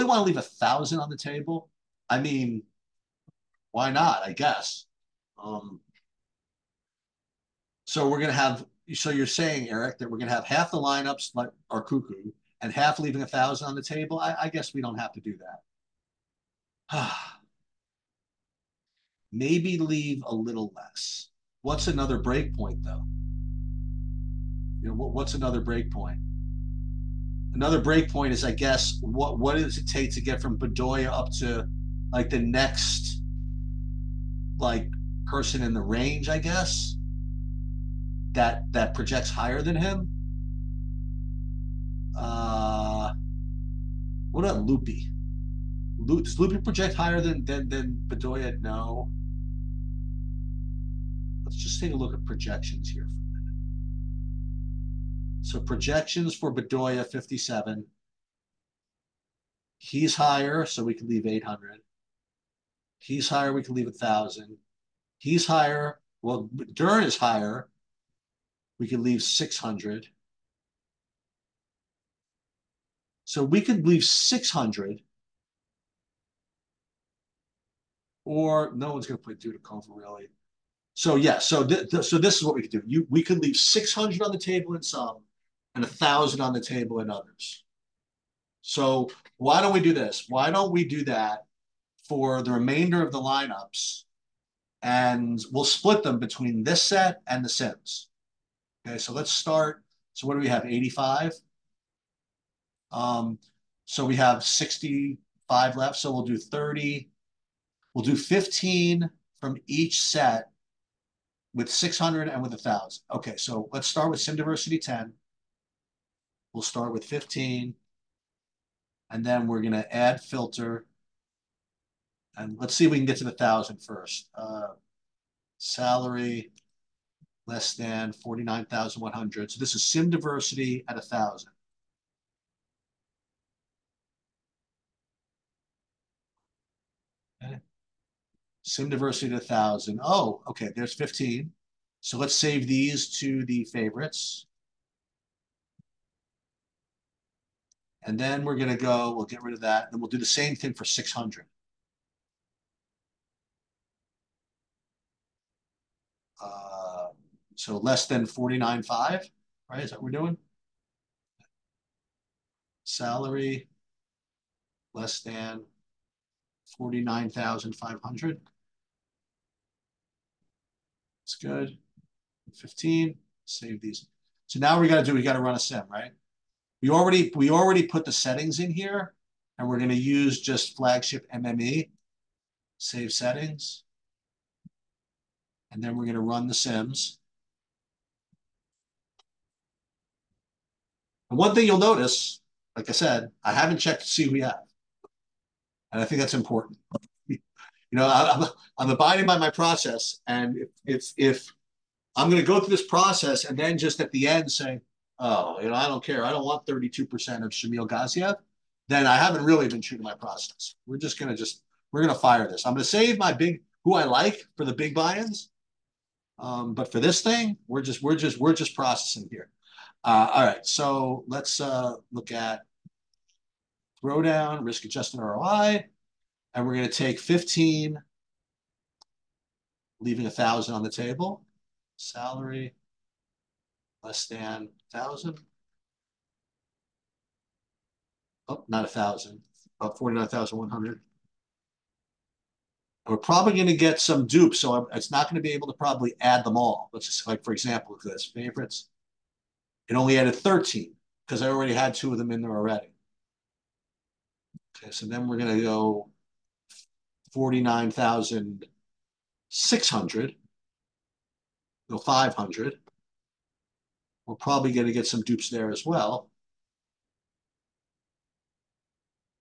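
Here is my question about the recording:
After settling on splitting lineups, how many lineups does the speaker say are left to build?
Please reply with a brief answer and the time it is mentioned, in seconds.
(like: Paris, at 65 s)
65, at 104 s.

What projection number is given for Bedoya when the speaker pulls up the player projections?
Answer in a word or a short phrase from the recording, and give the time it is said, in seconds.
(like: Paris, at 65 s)
57, at 57 s.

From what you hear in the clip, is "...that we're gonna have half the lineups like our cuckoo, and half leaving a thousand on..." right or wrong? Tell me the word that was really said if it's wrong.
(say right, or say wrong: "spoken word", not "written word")
right.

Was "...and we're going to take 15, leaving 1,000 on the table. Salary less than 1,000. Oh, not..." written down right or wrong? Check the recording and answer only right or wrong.
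right.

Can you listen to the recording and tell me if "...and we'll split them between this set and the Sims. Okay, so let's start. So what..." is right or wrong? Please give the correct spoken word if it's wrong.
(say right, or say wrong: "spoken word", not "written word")
right.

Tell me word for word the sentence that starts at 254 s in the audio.
Okay, so then we're going to go 49,600, no 500.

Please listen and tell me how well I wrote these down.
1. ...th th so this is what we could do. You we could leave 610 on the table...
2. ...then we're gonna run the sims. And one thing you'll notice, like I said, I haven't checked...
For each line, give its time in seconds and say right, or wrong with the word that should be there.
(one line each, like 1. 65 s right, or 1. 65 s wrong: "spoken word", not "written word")
1. 81 s wrong: "600", not "610"
2. 185 s right.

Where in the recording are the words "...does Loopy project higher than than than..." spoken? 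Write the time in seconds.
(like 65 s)
46 s.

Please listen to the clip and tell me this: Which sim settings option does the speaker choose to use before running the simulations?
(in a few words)
flagship MME.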